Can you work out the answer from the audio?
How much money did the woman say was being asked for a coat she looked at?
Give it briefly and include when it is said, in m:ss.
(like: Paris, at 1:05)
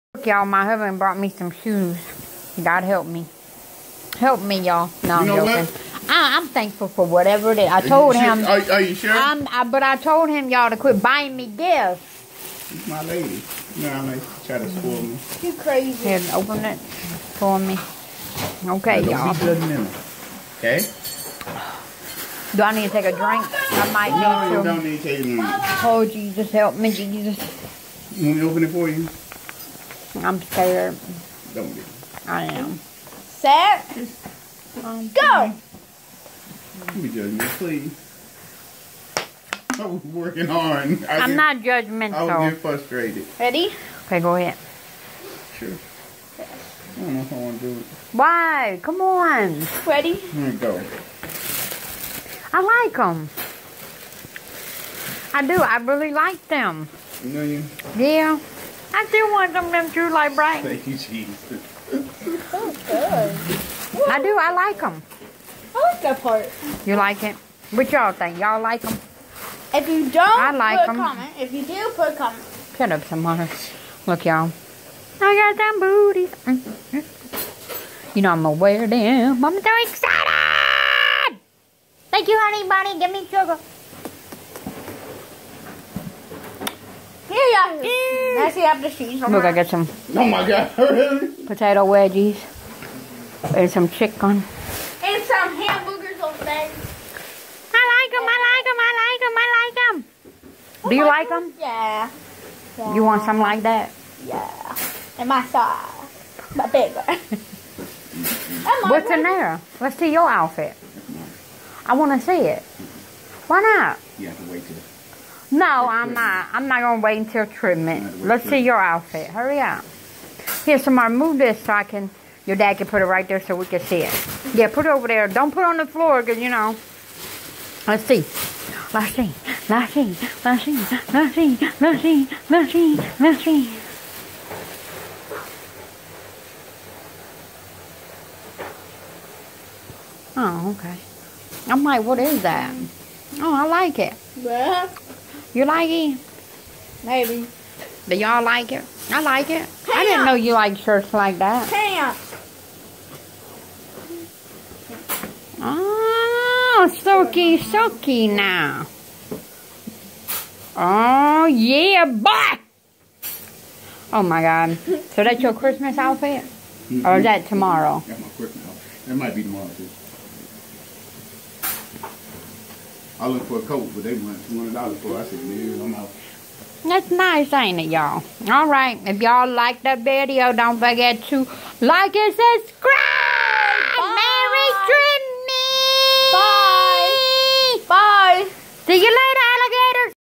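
$200, at 2:54.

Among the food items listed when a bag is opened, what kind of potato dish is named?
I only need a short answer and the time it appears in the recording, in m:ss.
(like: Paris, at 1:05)
Potato wedgies, at 1:31.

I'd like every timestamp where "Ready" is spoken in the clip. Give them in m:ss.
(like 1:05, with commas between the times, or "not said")
0:43, 0:49.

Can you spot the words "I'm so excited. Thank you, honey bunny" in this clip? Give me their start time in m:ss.
1:19.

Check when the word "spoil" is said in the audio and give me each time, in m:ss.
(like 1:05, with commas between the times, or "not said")
0:14.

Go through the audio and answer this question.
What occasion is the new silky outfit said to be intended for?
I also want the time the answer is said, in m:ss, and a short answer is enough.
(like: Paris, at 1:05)
Christmas, at 2:45.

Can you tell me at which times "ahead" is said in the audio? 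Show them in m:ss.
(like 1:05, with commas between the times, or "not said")
0:44.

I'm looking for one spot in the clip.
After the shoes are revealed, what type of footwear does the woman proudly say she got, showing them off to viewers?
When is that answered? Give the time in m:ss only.
1:15.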